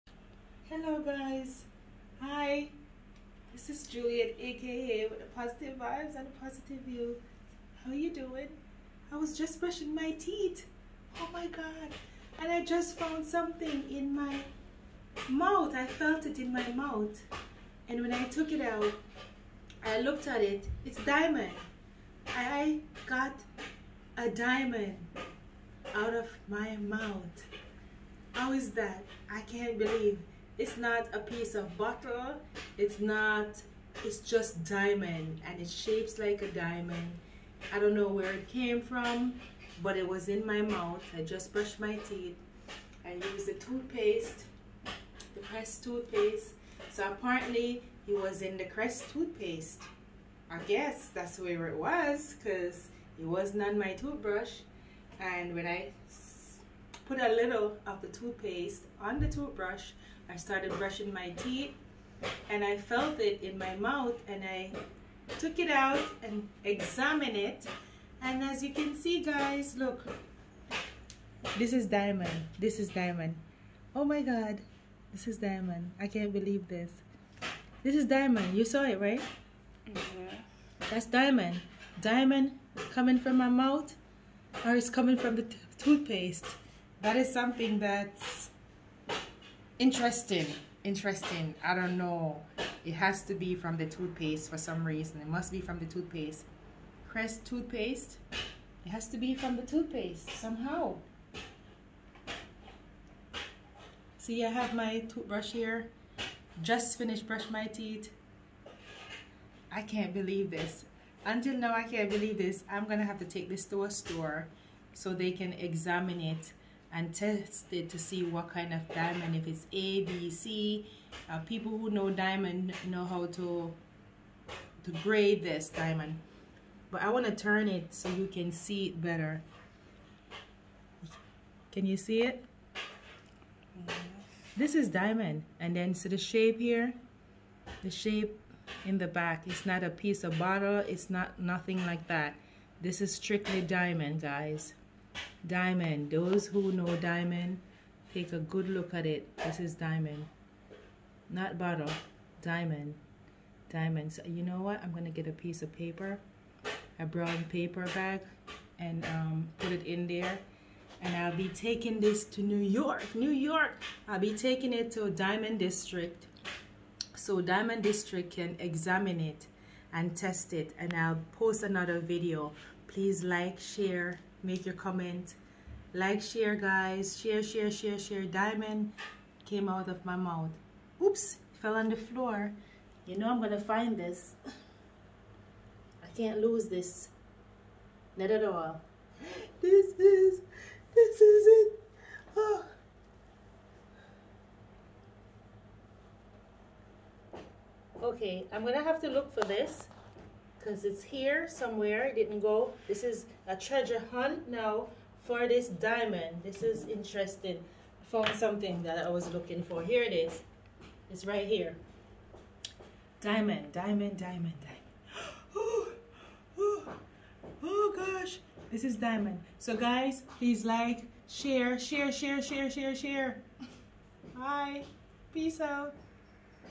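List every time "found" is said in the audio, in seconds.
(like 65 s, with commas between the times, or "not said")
12 s, 208 s.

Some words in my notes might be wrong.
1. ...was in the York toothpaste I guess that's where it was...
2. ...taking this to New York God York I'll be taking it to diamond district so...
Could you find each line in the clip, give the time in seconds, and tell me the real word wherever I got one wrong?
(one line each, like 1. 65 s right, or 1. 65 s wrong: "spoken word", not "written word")
1. 48 s wrong: "Crest", not "York"
2. 161 s wrong: "New", not "God".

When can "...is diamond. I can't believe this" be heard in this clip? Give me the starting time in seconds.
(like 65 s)
75 s.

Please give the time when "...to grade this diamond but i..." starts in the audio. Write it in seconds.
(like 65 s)
124 s.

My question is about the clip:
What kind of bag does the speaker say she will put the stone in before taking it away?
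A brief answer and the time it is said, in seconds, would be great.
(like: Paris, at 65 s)
brown paper bag, at 157 s.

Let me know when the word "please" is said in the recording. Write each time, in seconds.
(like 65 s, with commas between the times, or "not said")
172 s, 220 s.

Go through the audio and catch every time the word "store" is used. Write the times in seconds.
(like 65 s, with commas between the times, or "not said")
113 s.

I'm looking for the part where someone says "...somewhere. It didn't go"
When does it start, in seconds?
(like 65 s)
201 s.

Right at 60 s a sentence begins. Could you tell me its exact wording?
I started brushing my teeth and I felt it in my mouth and I took it out and examined it.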